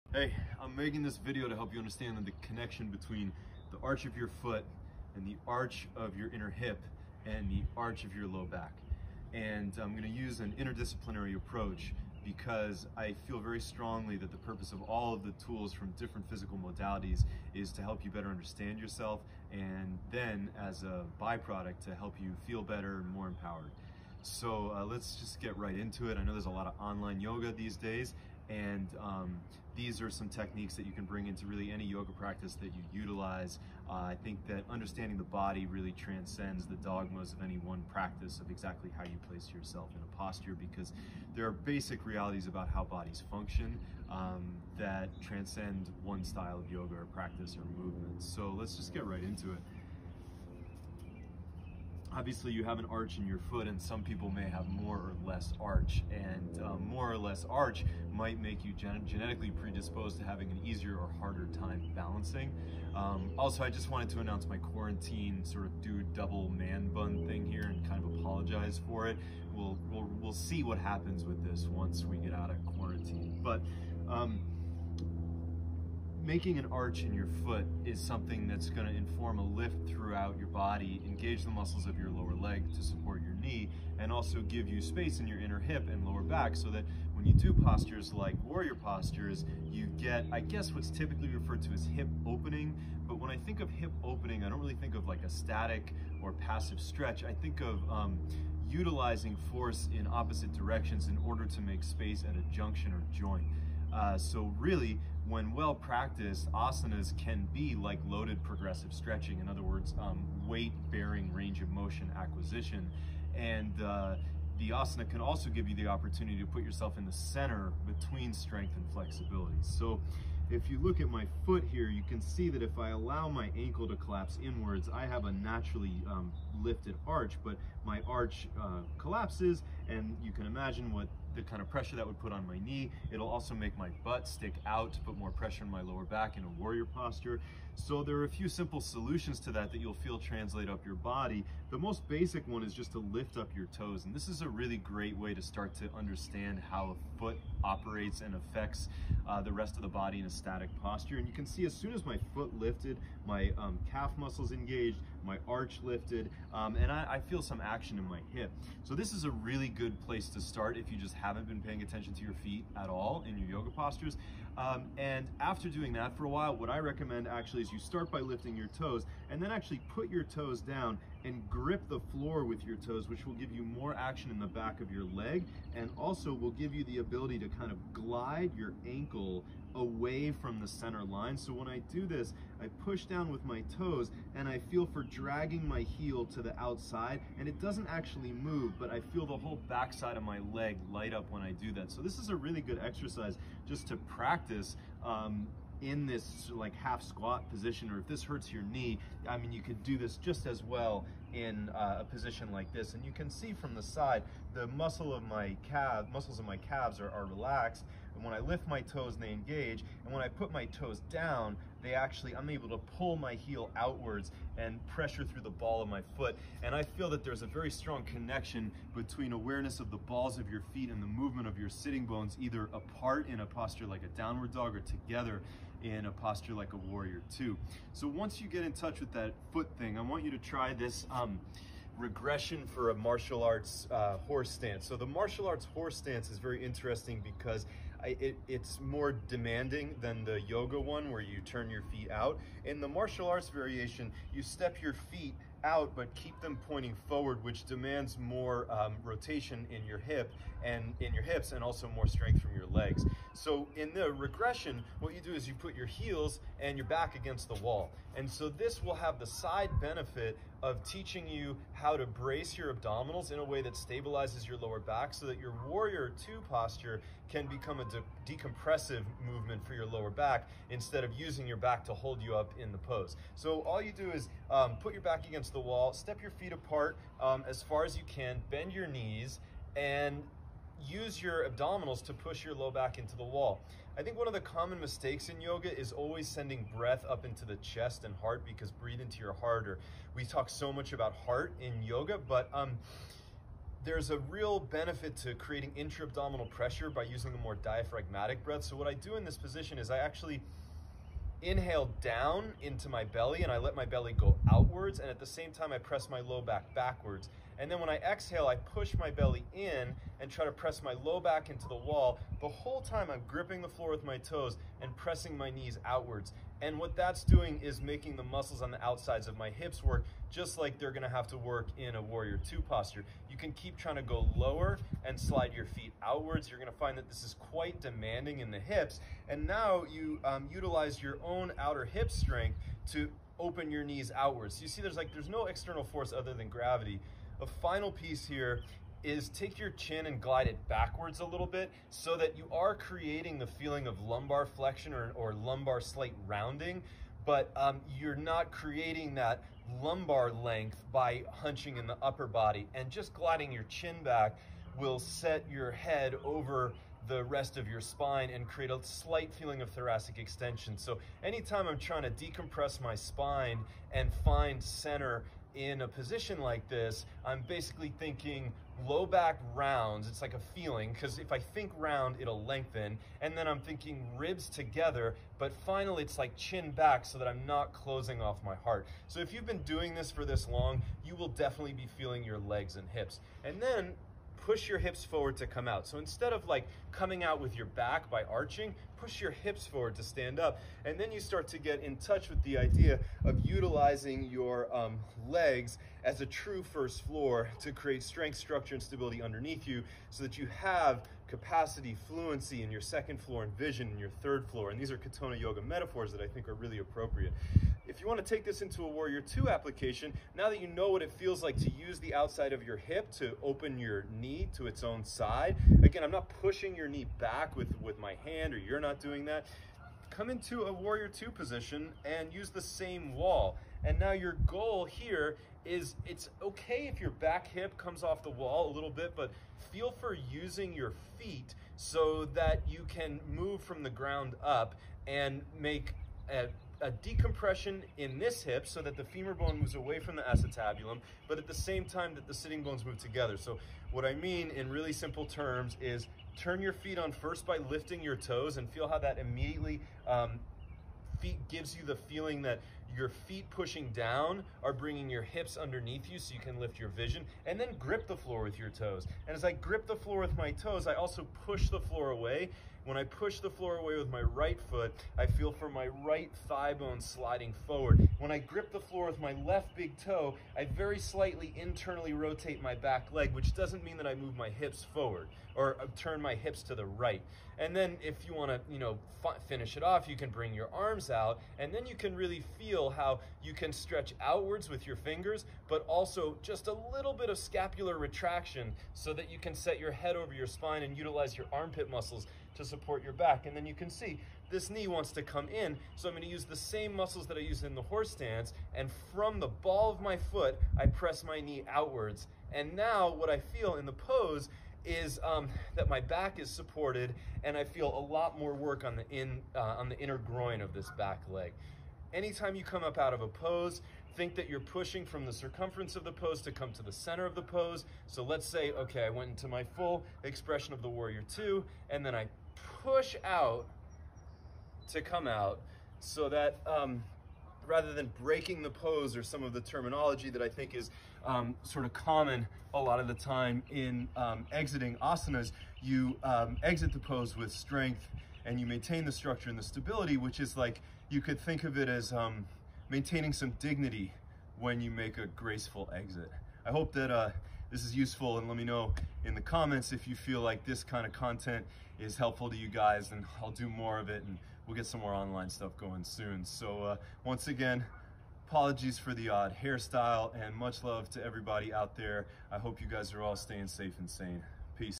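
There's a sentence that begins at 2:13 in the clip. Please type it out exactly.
It'll also make my butt stick out, put more pressure on my lower back in a warrior posture.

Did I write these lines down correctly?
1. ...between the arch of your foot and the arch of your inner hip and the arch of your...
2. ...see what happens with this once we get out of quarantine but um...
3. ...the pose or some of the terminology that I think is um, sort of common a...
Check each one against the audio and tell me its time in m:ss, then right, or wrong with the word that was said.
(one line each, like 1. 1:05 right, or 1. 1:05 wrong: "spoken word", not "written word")
1. 0:02 right
2. 1:10 right
3. 8:48 right.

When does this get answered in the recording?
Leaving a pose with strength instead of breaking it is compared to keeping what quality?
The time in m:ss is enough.
9:03.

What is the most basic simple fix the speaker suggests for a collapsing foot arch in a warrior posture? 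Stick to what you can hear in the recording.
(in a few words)
lift up your toes.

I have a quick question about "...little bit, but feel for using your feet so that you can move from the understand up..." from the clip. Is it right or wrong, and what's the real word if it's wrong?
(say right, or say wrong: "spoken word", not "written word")
wrong: "ground", not "understand".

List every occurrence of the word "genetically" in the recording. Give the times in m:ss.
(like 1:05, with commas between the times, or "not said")
0:59.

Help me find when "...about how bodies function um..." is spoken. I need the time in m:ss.
0:42.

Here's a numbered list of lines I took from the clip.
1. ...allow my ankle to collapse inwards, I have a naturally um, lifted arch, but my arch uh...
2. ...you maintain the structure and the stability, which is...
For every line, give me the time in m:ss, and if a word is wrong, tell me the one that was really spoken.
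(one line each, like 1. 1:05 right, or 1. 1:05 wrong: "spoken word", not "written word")
1. 2:02 right
2. 8:58 right.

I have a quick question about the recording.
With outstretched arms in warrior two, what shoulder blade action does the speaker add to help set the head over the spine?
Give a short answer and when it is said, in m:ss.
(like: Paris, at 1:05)
scapular retraction, at 8:07.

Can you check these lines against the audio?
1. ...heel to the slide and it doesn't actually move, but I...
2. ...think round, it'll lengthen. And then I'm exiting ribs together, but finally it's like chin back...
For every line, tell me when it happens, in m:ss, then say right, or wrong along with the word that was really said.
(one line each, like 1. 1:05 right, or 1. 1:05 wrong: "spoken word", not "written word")
1. 3:05 wrong: "outside", not "slide"
2. 6:11 wrong: "thinking", not "exiting".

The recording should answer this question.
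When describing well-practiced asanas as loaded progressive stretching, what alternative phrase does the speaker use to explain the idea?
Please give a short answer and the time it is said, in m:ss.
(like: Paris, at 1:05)
weight bearing range of motion acquisition, at 1:50.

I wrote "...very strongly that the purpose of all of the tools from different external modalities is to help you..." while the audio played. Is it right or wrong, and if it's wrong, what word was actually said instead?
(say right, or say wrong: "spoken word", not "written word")
wrong: "physical", not "external".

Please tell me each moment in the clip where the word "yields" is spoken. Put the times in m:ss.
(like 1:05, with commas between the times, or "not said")
not said.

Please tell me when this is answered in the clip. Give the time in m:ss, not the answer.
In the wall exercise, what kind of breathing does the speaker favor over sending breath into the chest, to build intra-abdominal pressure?
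4:57.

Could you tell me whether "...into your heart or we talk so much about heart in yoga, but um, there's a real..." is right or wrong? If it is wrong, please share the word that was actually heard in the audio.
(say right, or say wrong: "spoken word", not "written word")
right.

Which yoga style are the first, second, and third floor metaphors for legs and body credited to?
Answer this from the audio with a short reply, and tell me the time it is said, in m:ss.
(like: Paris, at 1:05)
Katonah Yoga, at 6:44.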